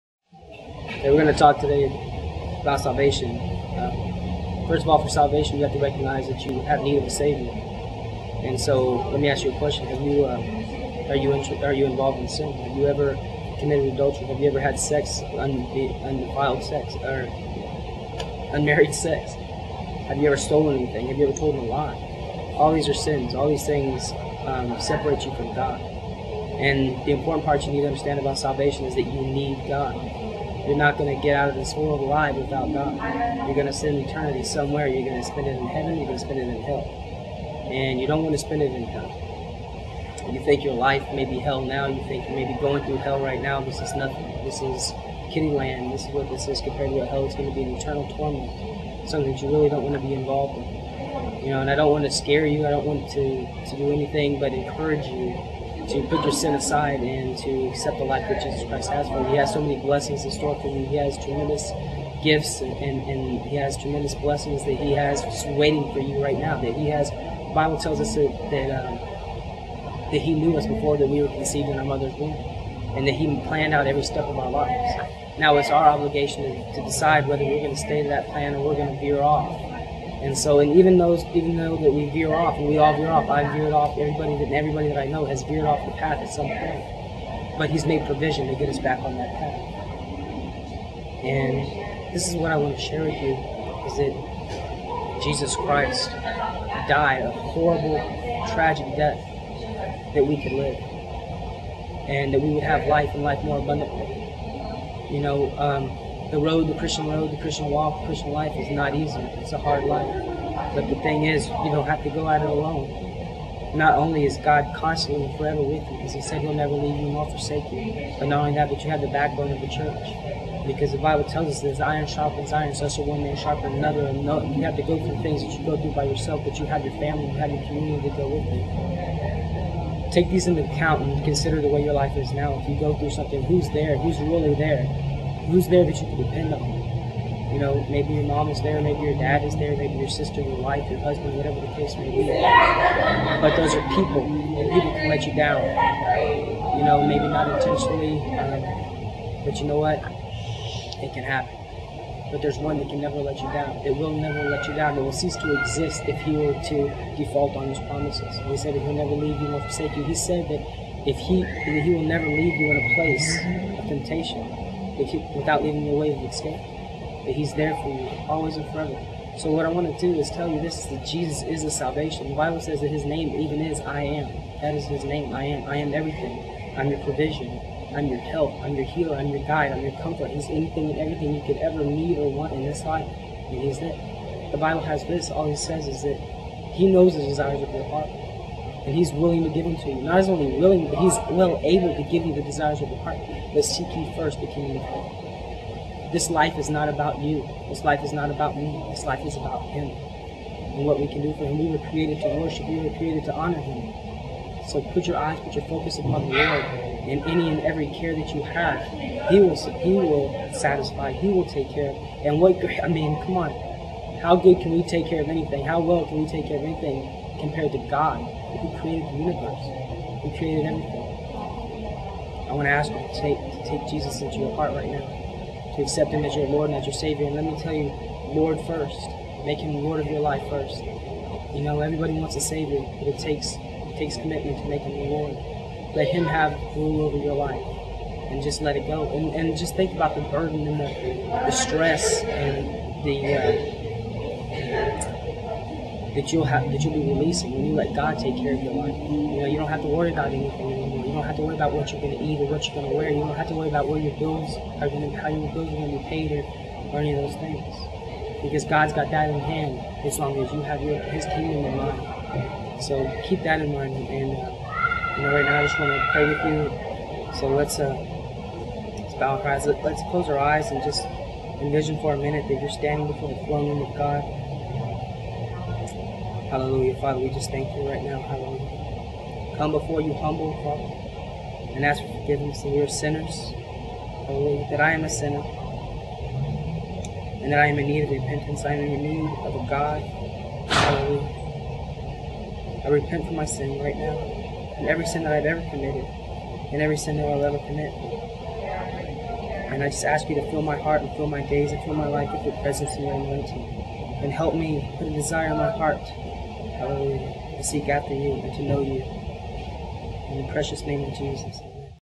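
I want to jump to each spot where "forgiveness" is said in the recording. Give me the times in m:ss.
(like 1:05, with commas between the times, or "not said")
4:42.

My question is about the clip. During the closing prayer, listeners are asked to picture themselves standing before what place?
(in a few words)
the throne room of God.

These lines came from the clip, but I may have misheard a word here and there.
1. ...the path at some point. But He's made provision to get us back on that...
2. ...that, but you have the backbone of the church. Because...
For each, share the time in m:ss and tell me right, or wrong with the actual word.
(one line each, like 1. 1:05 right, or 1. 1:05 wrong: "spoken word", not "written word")
1. 1:25 right
2. 1:58 right.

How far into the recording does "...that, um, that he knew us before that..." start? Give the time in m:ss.
1:08.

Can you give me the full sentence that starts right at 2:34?
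It will cease to exist if he were to default on his promises.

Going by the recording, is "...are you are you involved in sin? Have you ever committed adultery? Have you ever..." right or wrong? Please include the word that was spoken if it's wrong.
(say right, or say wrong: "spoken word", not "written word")
right.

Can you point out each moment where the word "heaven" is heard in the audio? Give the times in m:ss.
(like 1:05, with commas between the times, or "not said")
0:35, 3:14.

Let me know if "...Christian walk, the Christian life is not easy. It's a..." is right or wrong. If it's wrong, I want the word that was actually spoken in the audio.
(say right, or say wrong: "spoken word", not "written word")
right.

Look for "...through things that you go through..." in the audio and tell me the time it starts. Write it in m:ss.
2:04.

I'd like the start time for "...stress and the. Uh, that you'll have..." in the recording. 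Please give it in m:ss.
4:01.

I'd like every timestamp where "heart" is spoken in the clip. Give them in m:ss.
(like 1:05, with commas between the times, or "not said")
3:07, 3:13, 3:44, 5:00, 5:05.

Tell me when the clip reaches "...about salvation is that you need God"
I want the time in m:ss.
0:28.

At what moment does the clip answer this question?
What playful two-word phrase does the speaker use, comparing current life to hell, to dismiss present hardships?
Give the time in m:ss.
0:45.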